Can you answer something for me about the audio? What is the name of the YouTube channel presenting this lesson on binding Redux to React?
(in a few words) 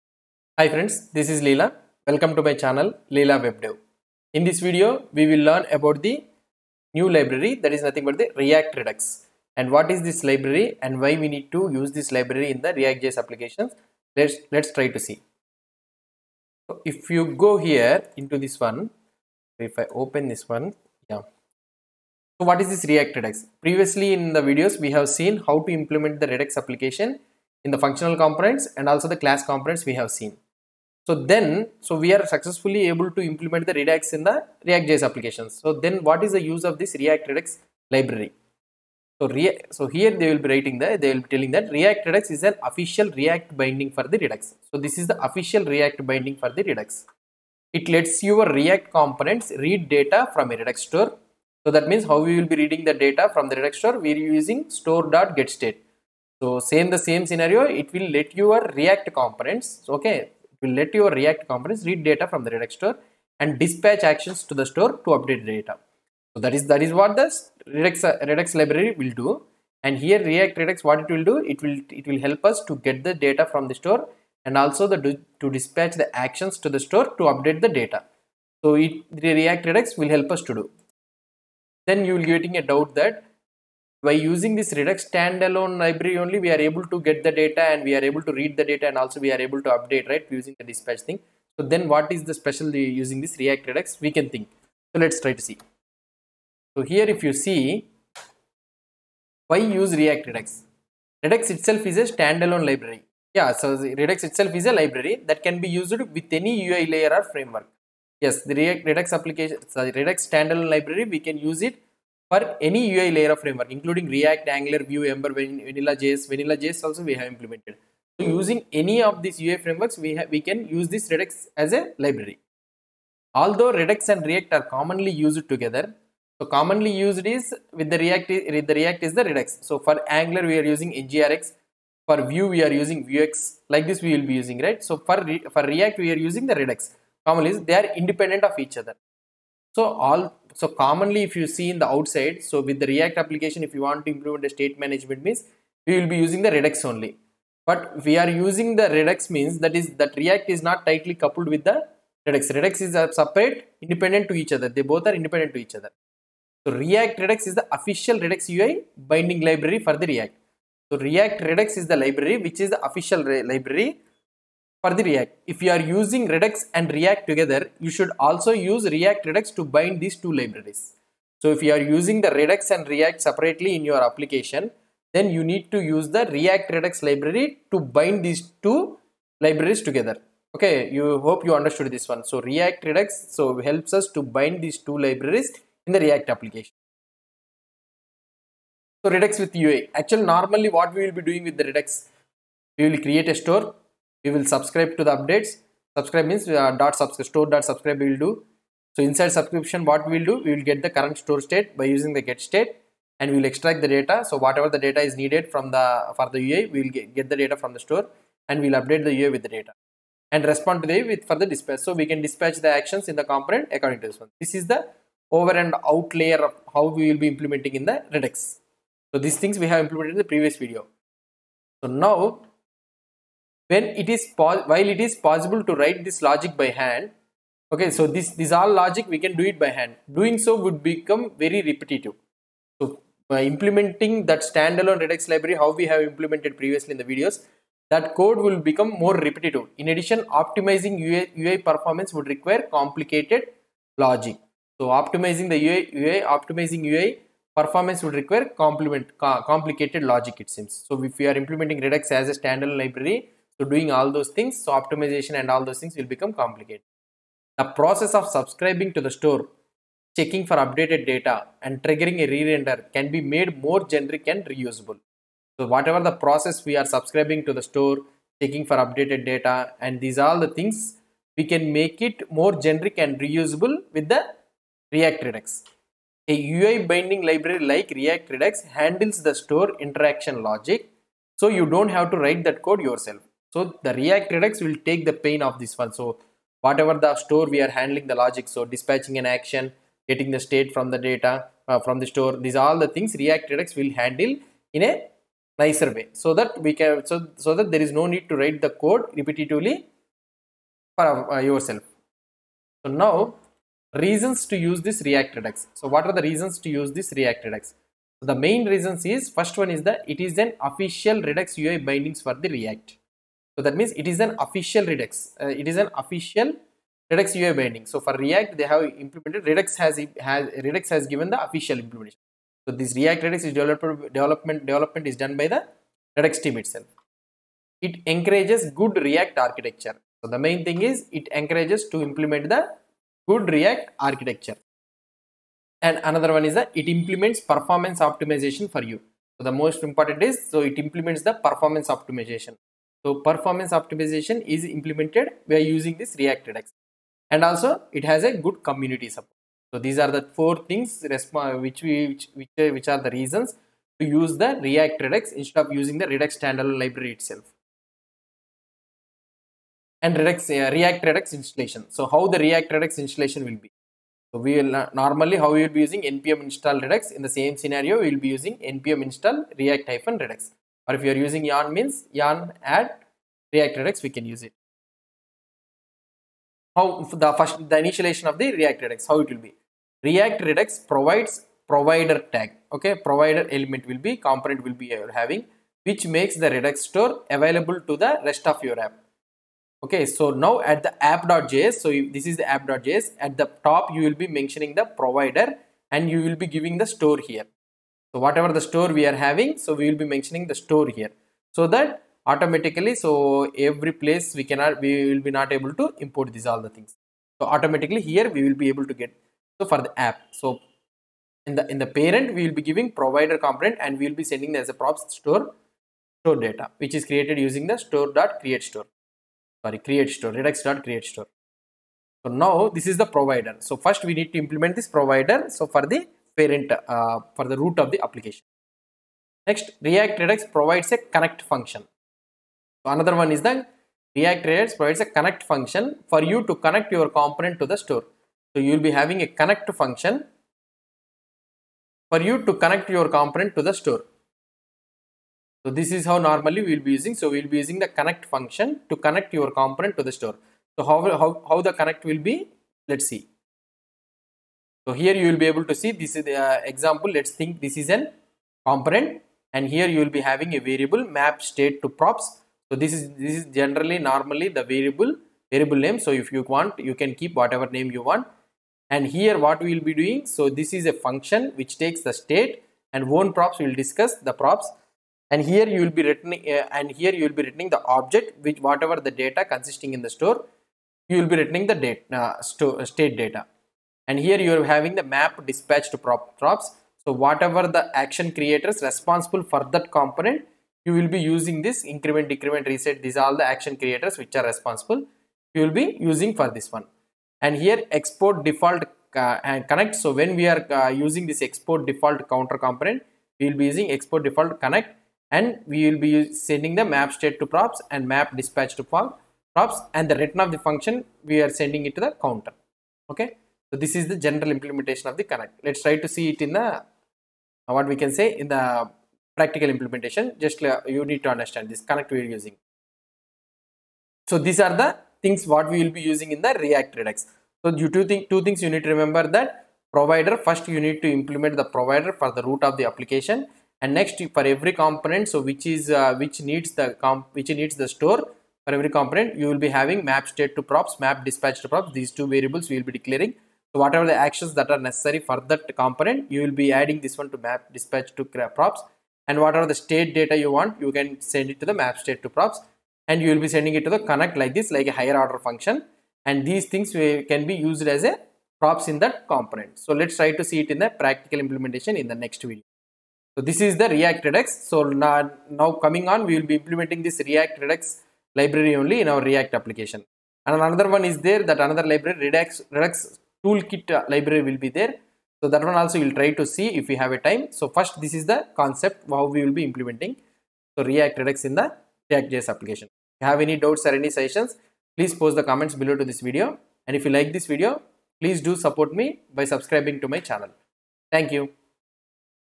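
Leela WebDev.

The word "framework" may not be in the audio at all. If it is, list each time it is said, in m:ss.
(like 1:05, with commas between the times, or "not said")
1:47, 1:53, 1:59.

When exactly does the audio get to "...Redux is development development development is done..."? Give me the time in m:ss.
5:23.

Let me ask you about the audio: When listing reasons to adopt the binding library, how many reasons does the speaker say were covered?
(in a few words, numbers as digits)
4.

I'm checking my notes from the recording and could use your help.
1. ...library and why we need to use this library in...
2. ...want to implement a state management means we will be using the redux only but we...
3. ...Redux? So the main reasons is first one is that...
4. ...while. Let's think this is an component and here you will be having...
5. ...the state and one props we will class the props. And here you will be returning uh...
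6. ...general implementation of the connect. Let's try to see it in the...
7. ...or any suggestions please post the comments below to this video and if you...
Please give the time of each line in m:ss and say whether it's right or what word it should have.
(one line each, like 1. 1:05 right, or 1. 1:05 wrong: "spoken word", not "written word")
1. 0:10 right
2. 2:23 right
3. 5:07 right
4. 7:36 wrong: "example", not "while"
5. 7:52 wrong: "discuss", not "class"
6. 8:34 right
7. 9:43 right.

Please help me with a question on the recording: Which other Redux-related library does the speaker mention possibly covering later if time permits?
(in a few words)
Redux Toolkit.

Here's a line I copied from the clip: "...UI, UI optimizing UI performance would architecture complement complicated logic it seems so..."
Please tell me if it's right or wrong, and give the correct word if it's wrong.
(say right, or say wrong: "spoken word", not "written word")
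wrong: "require", not "architecture".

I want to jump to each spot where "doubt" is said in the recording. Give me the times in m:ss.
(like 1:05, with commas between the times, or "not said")
1:22, 9:43.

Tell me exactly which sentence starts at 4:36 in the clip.
A UI binding library like React Redux handles the store interaction logic so you don't have to write that code yourself.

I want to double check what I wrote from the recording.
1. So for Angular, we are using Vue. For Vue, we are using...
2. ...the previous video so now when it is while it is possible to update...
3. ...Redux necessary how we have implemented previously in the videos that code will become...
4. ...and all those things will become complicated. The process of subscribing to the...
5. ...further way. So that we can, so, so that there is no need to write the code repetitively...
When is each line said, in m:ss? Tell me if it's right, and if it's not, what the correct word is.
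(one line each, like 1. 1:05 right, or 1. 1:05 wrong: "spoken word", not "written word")
1. 2:09 wrong: "NGRX", not "Vue"
2. 3:40 wrong: "write", not "update"
3. 3:55 wrong: "library", not "necessary"
4. 4:15 right
5. 4:55 wrong: "nicer", not "further".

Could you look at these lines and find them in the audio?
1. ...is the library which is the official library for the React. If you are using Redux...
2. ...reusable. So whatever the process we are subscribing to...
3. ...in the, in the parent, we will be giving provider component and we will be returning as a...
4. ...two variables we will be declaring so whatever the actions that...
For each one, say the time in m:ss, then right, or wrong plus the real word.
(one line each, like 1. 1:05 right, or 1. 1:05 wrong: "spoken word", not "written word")
1. 2:41 right
2. 4:24 right
3. 6:51 wrong: "sending", not "returning"
4. 9:02 right.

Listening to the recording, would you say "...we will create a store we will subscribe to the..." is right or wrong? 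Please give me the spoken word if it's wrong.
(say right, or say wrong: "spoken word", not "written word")
right.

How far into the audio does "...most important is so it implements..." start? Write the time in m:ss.
5:39.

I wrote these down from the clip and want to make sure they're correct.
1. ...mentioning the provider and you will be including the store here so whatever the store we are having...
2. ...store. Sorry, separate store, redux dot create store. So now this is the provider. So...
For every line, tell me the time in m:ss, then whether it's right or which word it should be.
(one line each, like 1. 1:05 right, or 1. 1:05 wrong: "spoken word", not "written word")
1. 6:34 wrong: "giving", not "including"
2. 6:58 wrong: "create", not "separate".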